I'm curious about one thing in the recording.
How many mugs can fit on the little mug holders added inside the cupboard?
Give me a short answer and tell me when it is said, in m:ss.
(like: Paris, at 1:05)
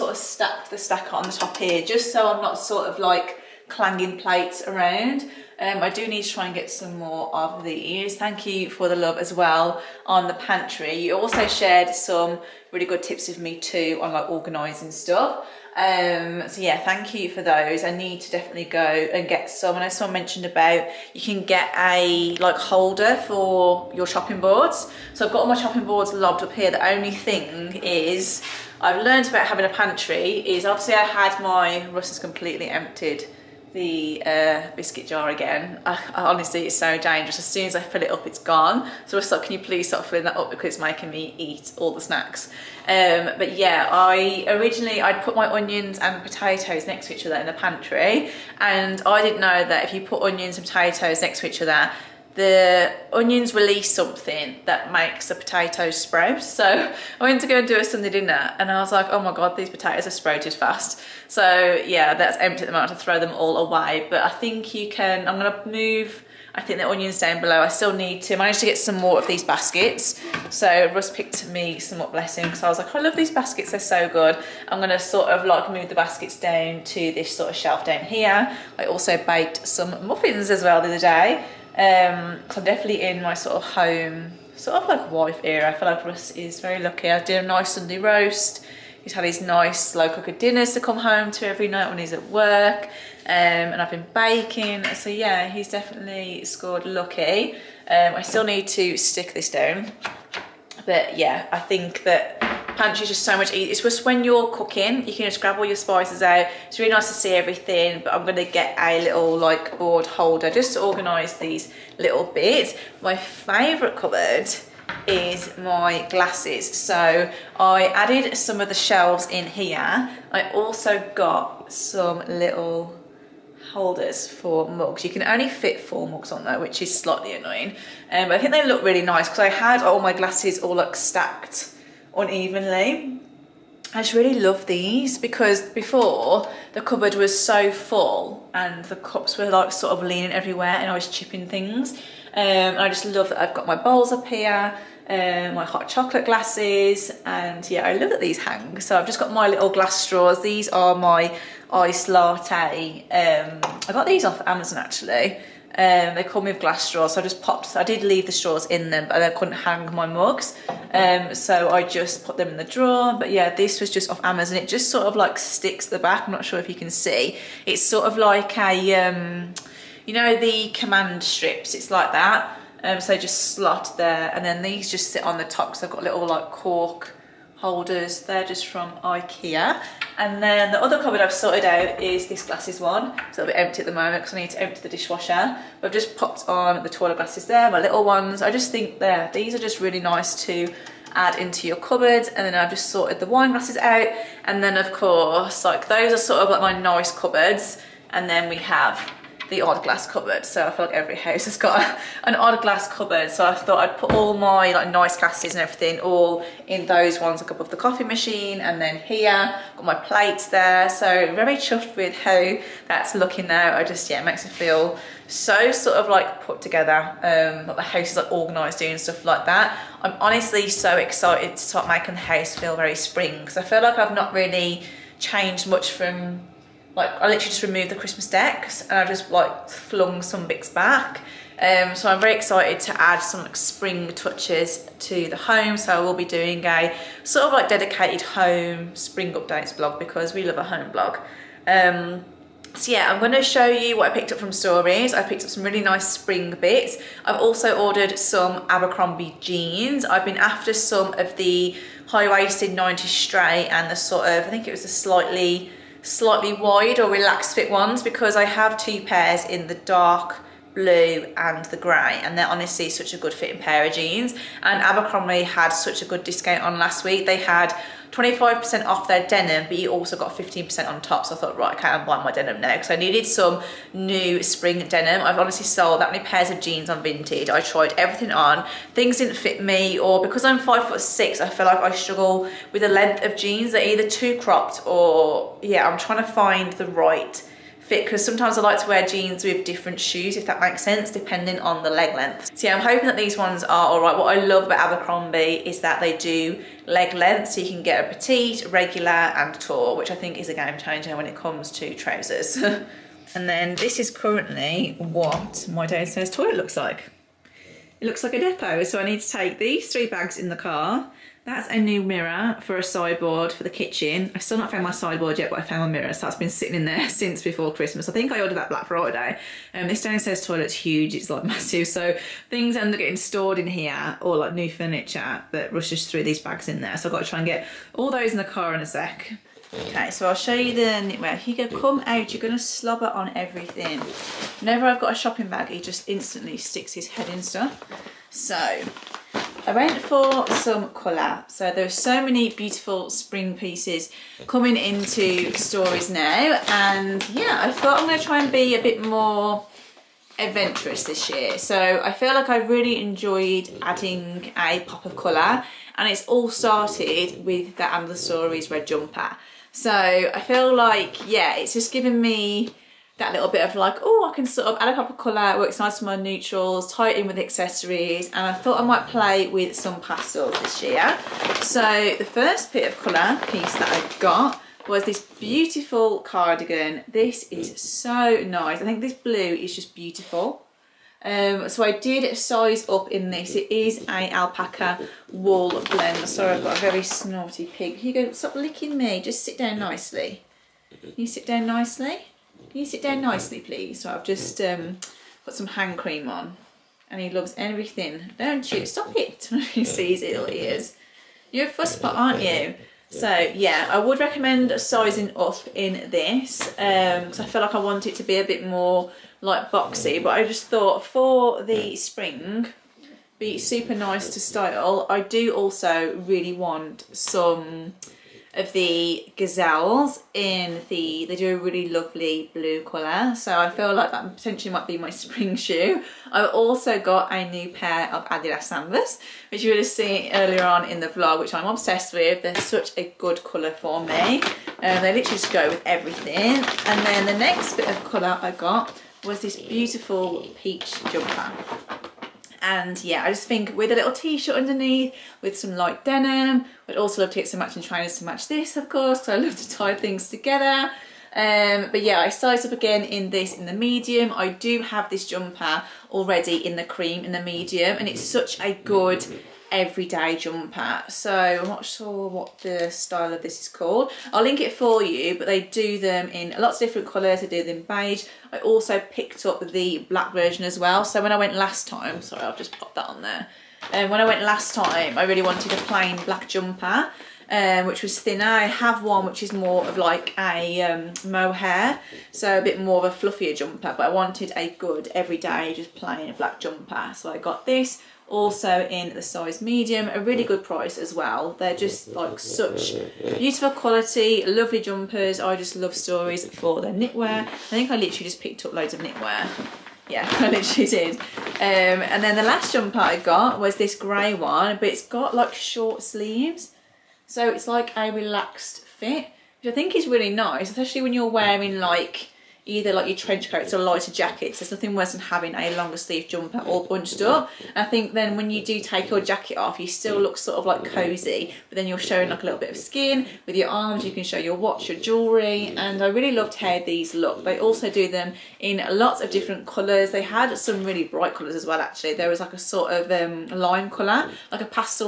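4, at 2:05.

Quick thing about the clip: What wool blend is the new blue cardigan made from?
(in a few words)
Alpaca.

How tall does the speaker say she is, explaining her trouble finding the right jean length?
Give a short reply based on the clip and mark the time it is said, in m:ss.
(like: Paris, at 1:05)
5 foot 6, at 4:40.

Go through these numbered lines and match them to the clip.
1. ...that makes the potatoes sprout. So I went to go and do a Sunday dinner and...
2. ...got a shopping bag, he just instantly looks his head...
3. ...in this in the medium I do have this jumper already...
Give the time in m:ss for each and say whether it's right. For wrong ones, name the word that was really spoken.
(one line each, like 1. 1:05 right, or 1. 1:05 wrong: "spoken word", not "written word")
1. 0:54 right
2. 5:35 wrong: "sticks", not "looks"
3. 7:33 right.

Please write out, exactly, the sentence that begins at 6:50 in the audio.
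But I just thought for the spring, be super nice to style.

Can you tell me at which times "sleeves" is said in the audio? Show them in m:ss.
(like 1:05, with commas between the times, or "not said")
8:26, 8:35.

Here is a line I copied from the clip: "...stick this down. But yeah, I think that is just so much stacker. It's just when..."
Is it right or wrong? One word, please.
wrong.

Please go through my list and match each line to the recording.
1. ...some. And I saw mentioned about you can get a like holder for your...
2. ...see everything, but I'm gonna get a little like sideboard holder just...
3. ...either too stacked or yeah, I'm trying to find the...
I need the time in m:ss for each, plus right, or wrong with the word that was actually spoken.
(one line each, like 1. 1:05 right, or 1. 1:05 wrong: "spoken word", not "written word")
1. 0:19 right
2. 1:47 wrong: "board", not "sideboard"
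3. 4:43 wrong: "cropped", not "stacked".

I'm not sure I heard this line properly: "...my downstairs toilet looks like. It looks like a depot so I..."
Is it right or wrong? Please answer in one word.
right.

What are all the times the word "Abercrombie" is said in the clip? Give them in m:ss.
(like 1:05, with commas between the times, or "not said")
4:08, 4:24, 4:54.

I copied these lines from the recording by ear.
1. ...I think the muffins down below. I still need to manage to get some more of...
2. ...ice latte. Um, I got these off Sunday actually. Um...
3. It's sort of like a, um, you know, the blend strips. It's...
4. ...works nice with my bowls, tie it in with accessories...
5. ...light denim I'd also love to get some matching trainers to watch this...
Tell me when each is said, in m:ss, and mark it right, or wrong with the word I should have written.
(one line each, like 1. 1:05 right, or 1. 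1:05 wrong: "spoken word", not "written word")
1. 1:06 wrong: "onions", not "muffins"
2. 2:31 wrong: "Amazon", not "Sunday"
3. 2:47 wrong: "command", not "blend"
4. 6:05 wrong: "neutrals", not "bowls"
5. 7:25 wrong: "match", not "watch".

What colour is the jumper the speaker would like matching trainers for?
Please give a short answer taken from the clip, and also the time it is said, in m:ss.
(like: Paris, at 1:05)
Peach, at 7:20.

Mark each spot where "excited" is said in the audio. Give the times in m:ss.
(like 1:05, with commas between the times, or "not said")
3:40, 3:52.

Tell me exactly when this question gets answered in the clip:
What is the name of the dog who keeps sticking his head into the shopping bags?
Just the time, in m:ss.
5:31.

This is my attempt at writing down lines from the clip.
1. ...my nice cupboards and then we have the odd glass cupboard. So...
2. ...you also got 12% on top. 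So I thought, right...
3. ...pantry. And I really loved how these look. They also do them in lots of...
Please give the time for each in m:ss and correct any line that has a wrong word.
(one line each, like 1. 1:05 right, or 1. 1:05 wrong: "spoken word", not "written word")
1. 3:16 right
2. 4:29 wrong: "15", not "12"
3. 8:44 wrong: "jewelry", not "pantry".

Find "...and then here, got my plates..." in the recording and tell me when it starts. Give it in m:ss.
3:28.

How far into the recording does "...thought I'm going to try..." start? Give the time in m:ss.
5:47.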